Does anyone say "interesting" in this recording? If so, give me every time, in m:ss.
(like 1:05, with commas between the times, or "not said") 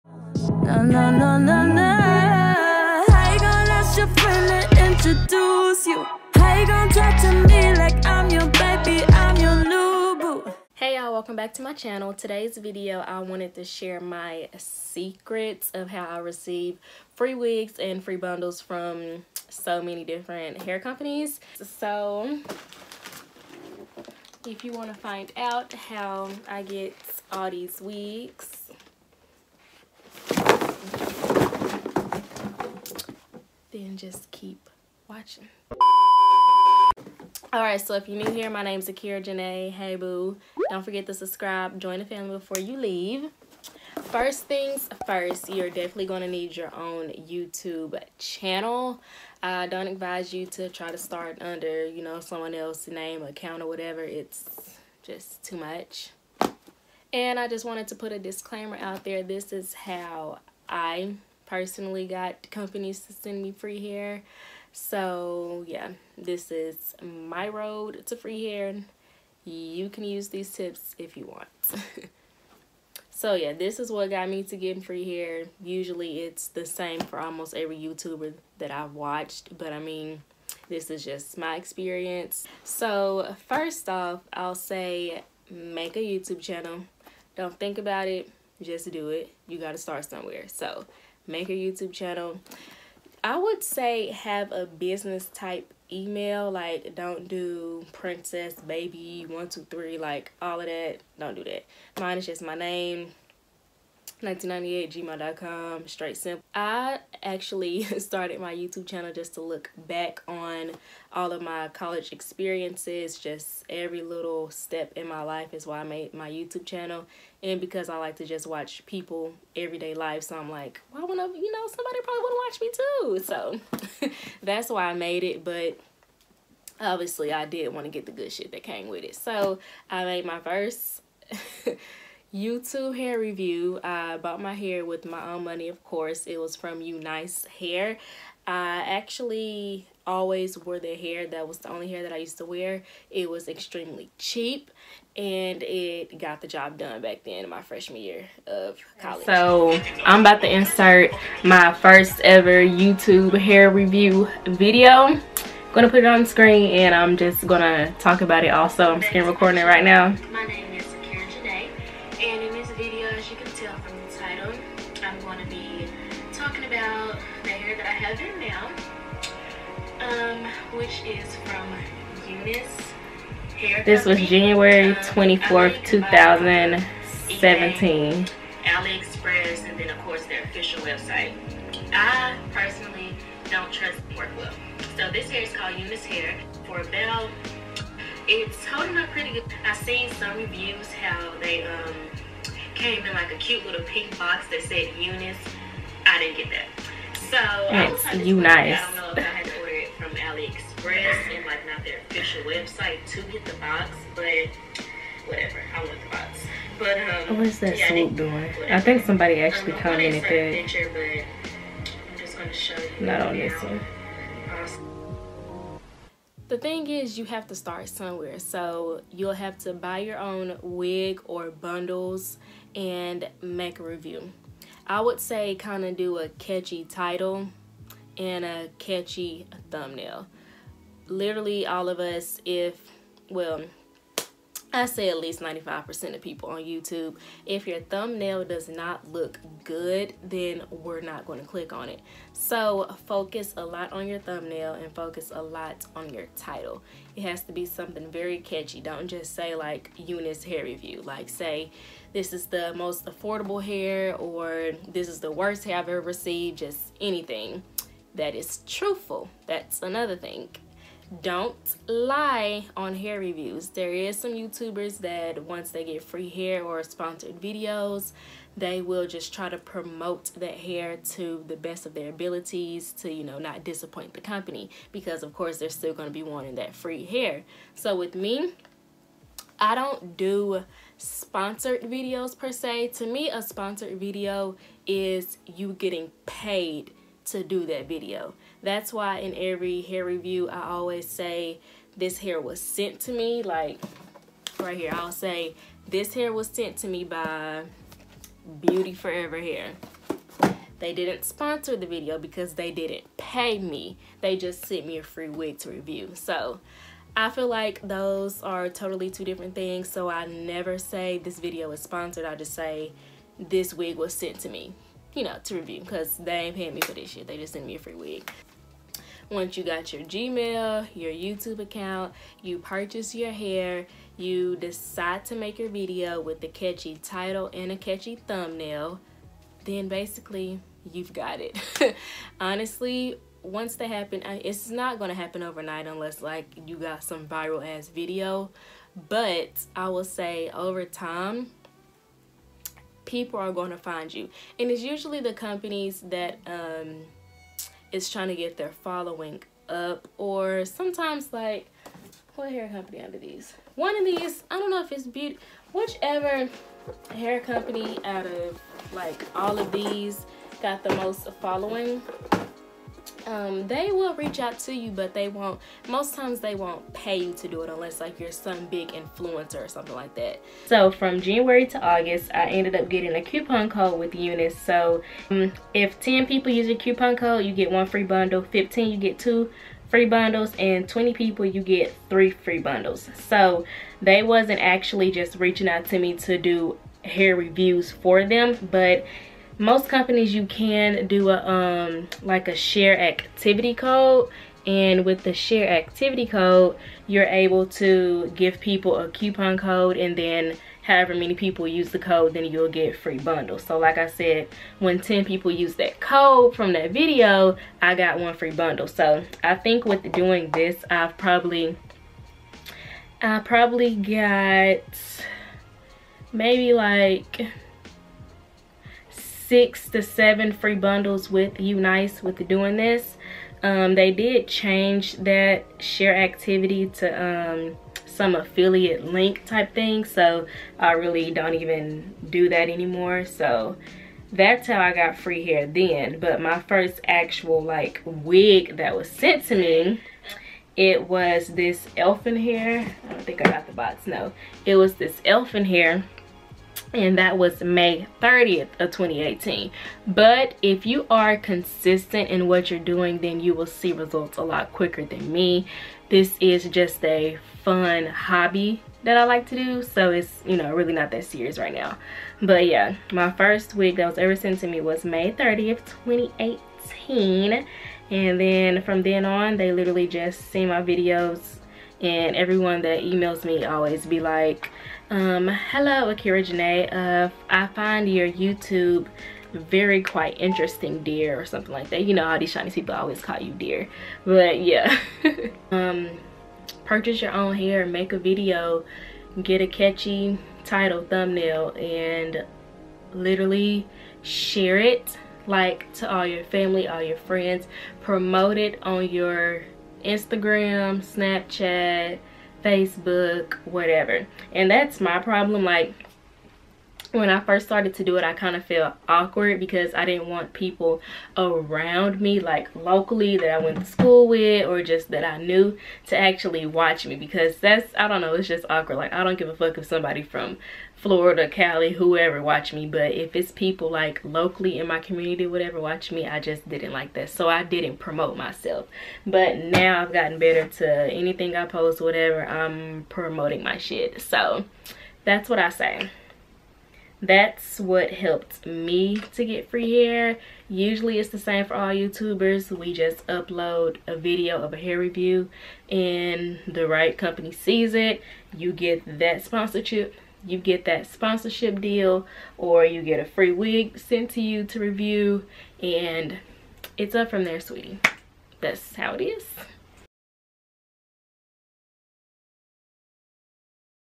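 8:00.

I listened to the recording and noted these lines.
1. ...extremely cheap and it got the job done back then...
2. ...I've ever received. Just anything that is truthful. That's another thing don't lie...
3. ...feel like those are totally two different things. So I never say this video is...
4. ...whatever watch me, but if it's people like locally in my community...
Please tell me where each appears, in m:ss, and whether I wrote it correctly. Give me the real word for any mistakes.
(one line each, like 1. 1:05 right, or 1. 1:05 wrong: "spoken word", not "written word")
1. 2:23 right
2. 4:15 right
3. 5:07 right
4. 8:41 wrong: "whoever", not "whatever".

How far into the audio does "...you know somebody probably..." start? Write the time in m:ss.
2:01.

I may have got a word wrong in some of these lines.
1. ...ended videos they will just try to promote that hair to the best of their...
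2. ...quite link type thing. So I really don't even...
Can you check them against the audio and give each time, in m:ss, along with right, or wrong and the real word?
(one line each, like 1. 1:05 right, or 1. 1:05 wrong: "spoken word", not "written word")
1. 4:26 wrong: "sponsored", not "ended"
2. 7:08 wrong: "affiliate", not "quite".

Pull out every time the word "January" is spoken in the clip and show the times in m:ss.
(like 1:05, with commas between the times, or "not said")
2:54, 6:11.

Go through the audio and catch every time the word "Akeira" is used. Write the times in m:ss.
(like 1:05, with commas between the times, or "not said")
0:38, 7:56.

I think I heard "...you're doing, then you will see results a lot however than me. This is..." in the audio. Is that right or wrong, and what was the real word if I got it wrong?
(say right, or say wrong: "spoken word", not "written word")
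wrong: "quicker", not "however".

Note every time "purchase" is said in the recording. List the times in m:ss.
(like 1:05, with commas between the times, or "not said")
5:22, 8:06.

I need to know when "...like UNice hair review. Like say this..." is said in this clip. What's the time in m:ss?
4:09.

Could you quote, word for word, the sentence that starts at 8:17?
Promote it on your Instagram, Snapchat, Facebook, whatever.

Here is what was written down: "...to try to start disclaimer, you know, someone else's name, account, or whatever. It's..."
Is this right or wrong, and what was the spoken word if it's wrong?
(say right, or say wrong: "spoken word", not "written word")
wrong: "under", not "disclaimer".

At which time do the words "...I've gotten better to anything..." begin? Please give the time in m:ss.
8:50.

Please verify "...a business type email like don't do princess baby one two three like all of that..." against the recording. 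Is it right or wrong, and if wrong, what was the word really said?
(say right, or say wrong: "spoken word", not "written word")
right.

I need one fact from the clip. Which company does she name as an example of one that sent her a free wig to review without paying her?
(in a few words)
Beauty Forever Hair.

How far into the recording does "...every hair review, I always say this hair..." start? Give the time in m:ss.
4:49.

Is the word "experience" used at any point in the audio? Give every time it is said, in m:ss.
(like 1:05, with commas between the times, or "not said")
1:21, 1:52.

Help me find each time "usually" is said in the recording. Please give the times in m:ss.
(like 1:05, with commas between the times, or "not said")
1:15, 5:44, 9:00.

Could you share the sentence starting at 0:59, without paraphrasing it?
This is how I personally got companies to send me free hair.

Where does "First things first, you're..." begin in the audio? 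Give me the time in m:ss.
0:44.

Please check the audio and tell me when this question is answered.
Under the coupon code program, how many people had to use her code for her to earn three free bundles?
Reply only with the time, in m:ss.
6:20.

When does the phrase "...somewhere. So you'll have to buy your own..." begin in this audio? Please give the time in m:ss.
3:37.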